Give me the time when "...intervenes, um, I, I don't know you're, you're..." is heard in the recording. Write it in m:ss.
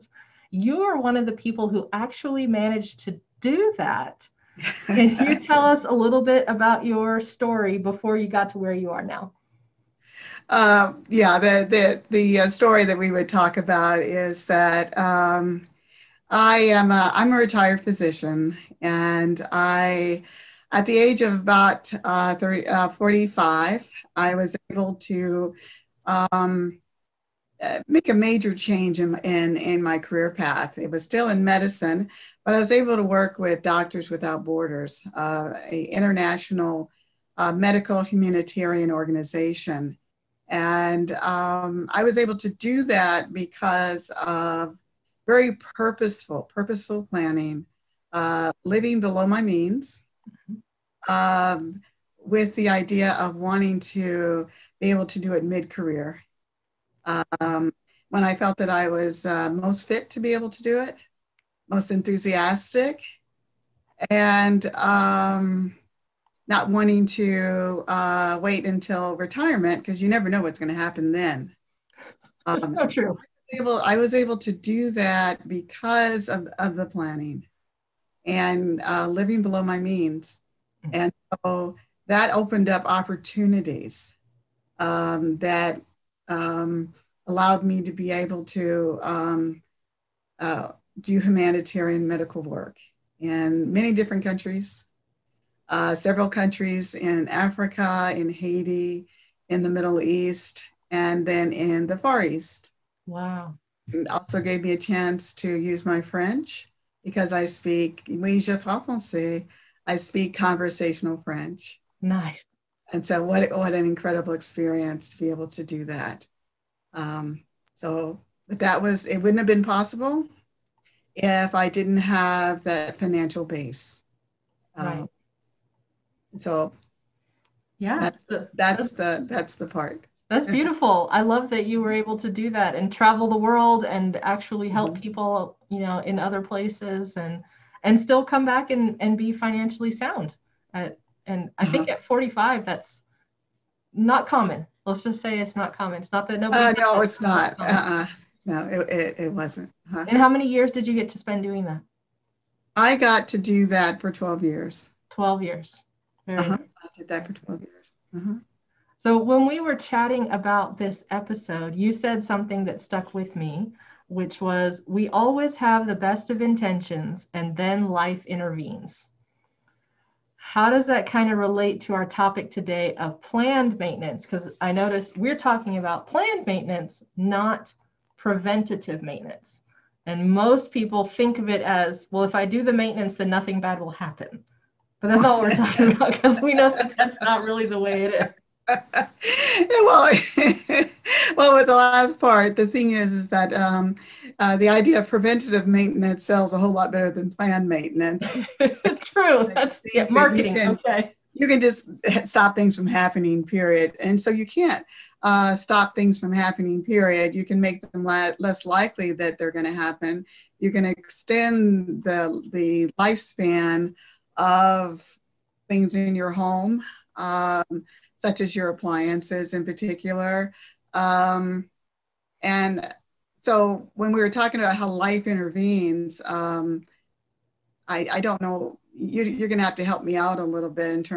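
3:45.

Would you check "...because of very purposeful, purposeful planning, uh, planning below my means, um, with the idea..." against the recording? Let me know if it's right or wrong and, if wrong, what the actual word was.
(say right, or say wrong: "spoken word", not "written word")
wrong: "living", not "planning".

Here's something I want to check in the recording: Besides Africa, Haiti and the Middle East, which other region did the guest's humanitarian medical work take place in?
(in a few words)
the Far East.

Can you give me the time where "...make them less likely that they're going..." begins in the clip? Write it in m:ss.
3:27.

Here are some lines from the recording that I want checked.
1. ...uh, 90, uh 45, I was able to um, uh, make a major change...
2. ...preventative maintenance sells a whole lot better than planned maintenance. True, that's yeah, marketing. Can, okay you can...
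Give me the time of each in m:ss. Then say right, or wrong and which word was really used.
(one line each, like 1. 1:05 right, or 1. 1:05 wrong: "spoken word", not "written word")
1. 0:22 wrong: "30", not "90"
2. 3:15 right.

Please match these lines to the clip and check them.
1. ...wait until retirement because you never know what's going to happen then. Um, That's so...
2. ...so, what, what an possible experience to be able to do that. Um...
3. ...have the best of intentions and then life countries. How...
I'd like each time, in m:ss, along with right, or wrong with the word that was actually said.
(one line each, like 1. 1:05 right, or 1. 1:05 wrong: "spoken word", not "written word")
1. 1:08 right
2. 1:53 wrong: "incredible", not "possible"
3. 2:45 wrong: "intervenes", not "countries".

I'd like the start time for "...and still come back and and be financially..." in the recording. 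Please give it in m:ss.
2:17.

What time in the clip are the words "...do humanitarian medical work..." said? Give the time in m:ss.
1:31.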